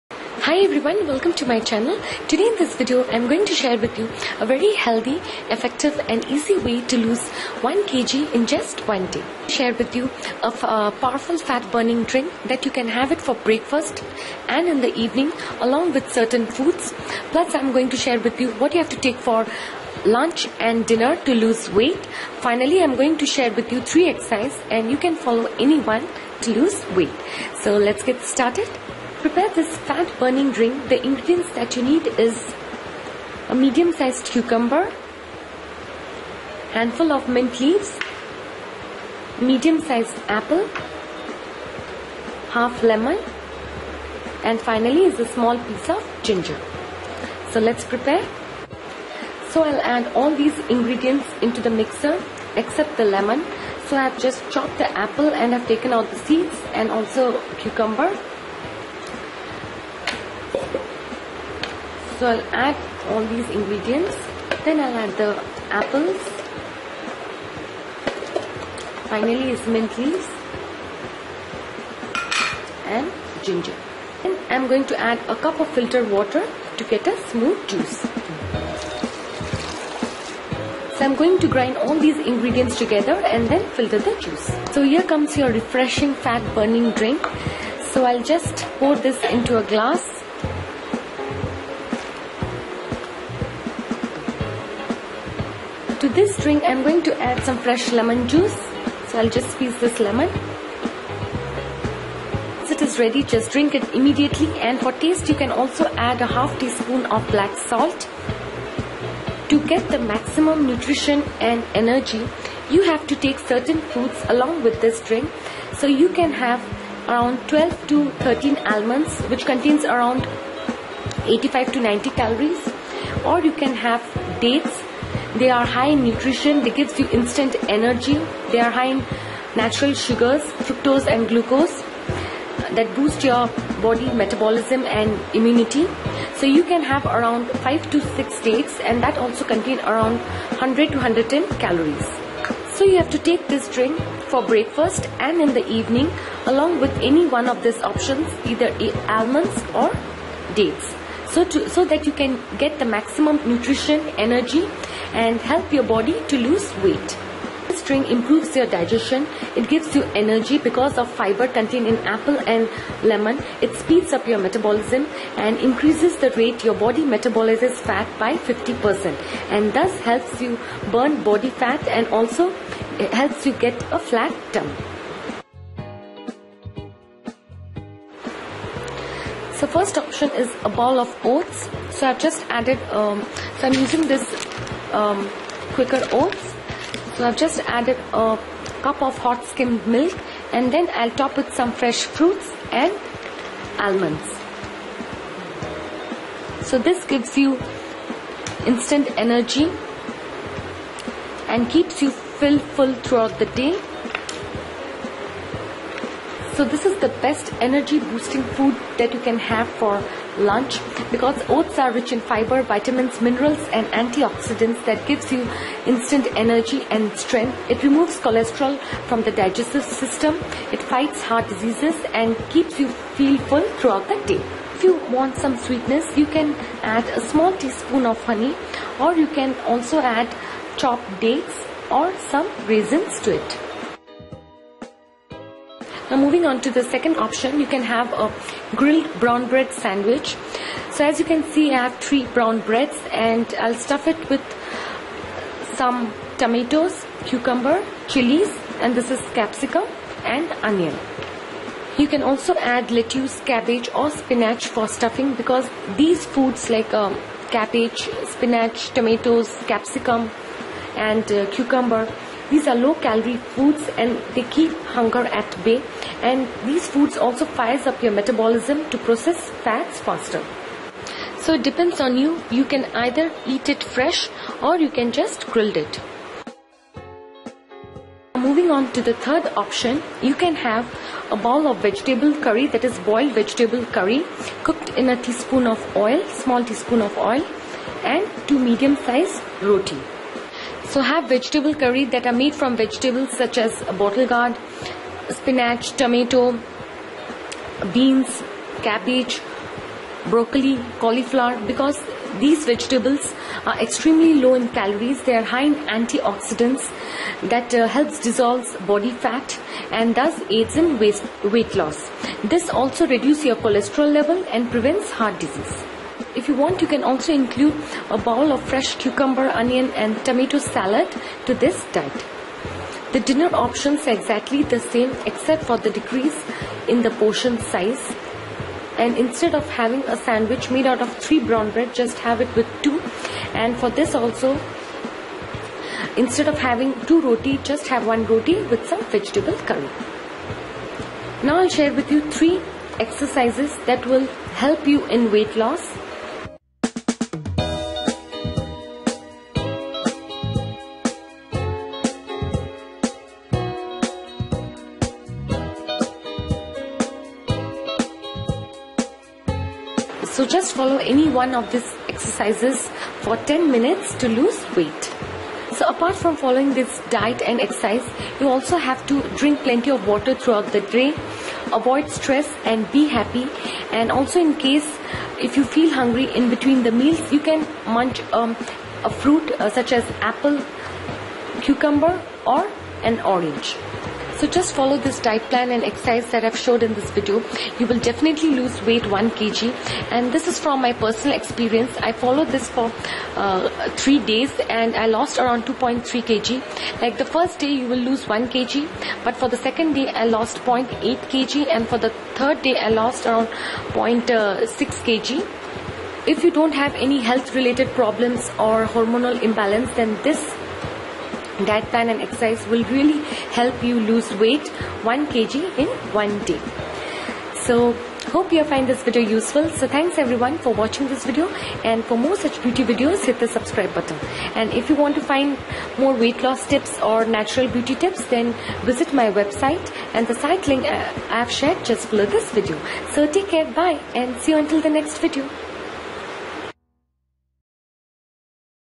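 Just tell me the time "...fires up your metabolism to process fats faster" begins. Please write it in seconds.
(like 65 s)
267 s.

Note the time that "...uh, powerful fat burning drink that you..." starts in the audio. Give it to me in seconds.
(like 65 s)
10 s.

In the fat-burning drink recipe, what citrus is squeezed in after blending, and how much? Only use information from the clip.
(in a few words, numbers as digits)
half lemon.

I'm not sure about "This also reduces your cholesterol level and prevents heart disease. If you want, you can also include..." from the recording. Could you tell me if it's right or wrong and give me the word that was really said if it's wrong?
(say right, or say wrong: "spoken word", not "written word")
right.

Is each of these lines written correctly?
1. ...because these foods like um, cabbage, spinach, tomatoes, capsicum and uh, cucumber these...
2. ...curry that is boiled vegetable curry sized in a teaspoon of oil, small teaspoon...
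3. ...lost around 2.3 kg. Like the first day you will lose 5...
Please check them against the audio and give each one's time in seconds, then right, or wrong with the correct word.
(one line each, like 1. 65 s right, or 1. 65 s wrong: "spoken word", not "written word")
1. 255 s right
2. 282 s wrong: "cooked", not "sized"
3. 395 s wrong: "1", not "5".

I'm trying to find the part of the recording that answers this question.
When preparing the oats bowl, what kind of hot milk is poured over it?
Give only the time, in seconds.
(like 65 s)
189 s.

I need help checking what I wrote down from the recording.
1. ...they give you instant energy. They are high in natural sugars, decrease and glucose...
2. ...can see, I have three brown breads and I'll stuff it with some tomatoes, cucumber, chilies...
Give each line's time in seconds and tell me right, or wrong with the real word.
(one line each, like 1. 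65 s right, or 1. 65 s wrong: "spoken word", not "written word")
1. 126 s wrong: "fructose", not "decrease"
2. 241 s right.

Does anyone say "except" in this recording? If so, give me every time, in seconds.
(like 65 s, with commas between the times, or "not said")
52 s, 325 s.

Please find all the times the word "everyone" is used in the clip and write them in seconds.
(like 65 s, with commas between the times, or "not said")
0 s, 420 s.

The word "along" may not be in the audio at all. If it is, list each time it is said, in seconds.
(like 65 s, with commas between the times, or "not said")
15 s, 114 s, 146 s.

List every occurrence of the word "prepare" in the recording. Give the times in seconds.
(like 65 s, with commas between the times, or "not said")
29 s, 47 s.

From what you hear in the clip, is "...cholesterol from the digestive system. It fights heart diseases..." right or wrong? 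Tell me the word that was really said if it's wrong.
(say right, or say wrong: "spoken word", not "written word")
right.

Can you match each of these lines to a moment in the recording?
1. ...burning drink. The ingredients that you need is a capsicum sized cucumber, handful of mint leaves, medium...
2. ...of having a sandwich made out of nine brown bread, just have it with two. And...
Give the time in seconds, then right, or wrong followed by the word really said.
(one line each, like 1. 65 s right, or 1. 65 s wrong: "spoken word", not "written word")
1. 30 s wrong: "medium", not "capsicum"
2. 329 s wrong: "three", not "nine".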